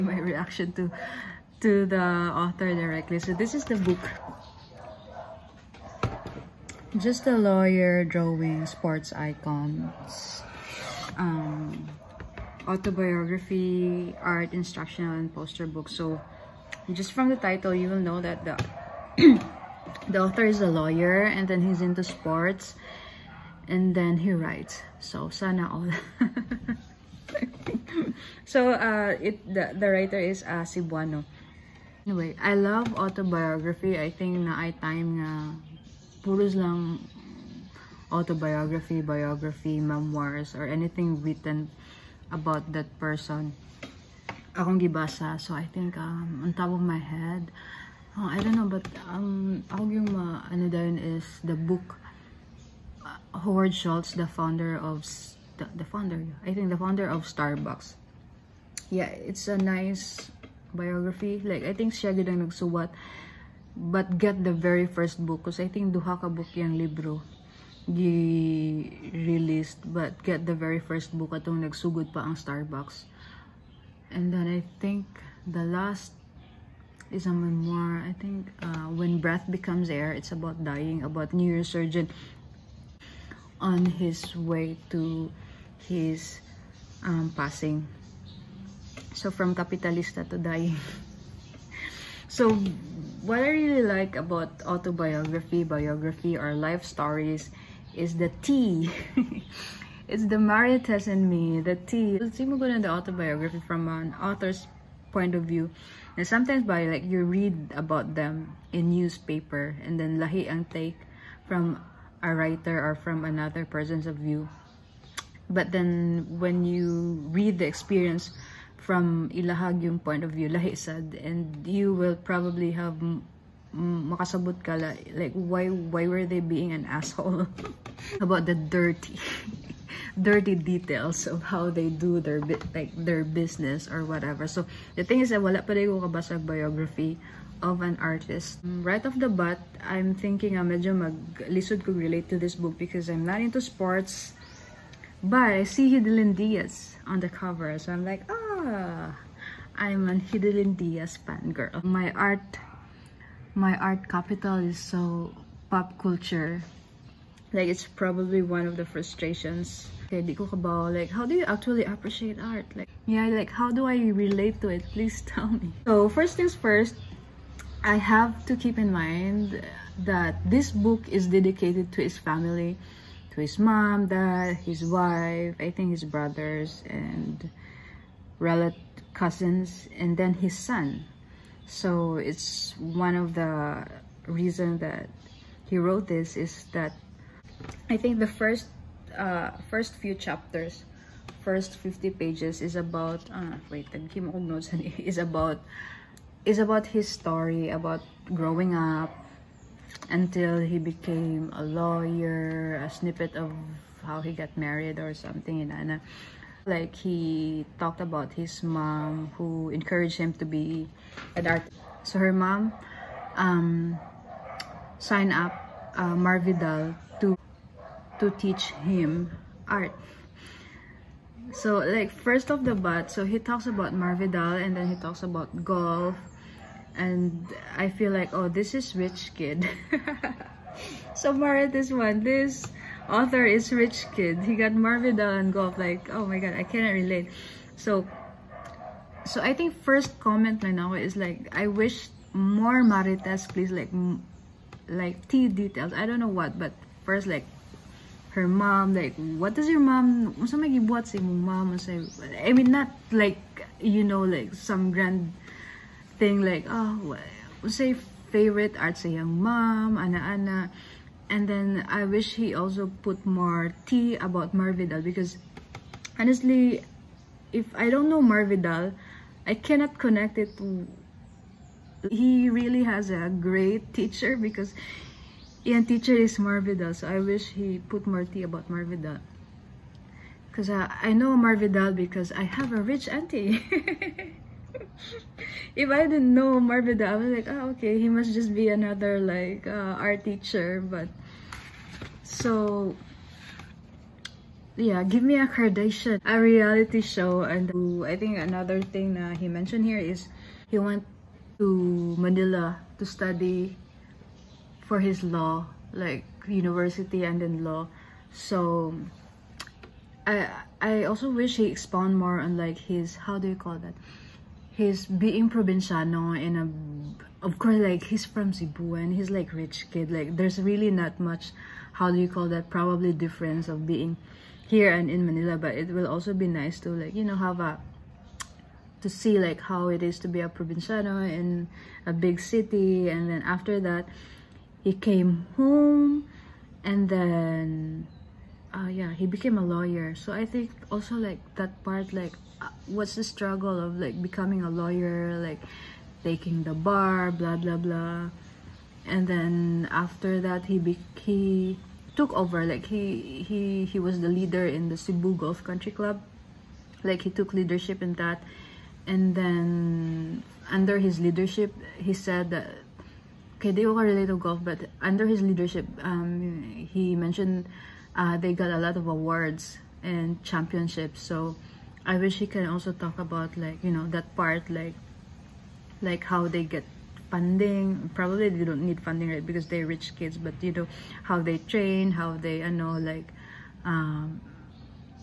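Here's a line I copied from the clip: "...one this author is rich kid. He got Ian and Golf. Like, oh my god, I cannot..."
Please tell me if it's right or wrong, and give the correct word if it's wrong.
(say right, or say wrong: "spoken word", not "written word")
wrong: "Marvin", not "Ian".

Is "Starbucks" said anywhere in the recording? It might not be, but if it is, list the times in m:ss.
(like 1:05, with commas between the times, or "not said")
0:57, 1:12.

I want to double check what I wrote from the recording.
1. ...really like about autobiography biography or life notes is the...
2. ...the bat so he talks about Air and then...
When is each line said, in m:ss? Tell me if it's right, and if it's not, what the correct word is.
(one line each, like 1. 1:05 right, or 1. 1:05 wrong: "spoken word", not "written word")
1. 1:33 wrong: "stories", not "notes"
2. 3:42 wrong: "Marvidal", not "Air".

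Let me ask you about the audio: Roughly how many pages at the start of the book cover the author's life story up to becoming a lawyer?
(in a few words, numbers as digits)
50.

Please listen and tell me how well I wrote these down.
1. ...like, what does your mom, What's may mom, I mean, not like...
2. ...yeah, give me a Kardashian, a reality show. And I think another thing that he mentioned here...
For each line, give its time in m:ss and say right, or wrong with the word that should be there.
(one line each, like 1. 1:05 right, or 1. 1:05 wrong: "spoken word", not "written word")
1. 4:08 right
2. 4:54 right.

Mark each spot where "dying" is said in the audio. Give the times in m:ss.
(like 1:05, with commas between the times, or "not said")
1:20, 1:30.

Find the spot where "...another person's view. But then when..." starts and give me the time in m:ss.
1:53.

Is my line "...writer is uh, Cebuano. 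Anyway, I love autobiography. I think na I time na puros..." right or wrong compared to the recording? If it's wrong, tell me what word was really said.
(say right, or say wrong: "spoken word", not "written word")
right.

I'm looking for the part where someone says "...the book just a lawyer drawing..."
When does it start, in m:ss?
0:03.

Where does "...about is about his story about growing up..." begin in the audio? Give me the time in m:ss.
3:15.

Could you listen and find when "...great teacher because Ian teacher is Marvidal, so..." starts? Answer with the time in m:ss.
4:33.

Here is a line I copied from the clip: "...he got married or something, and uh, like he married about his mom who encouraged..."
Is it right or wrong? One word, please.
wrong.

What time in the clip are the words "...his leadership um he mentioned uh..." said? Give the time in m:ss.
6:05.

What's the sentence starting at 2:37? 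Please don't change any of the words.
Like, it's probably one of the frustrations.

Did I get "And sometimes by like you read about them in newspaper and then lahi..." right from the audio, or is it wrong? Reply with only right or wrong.
right.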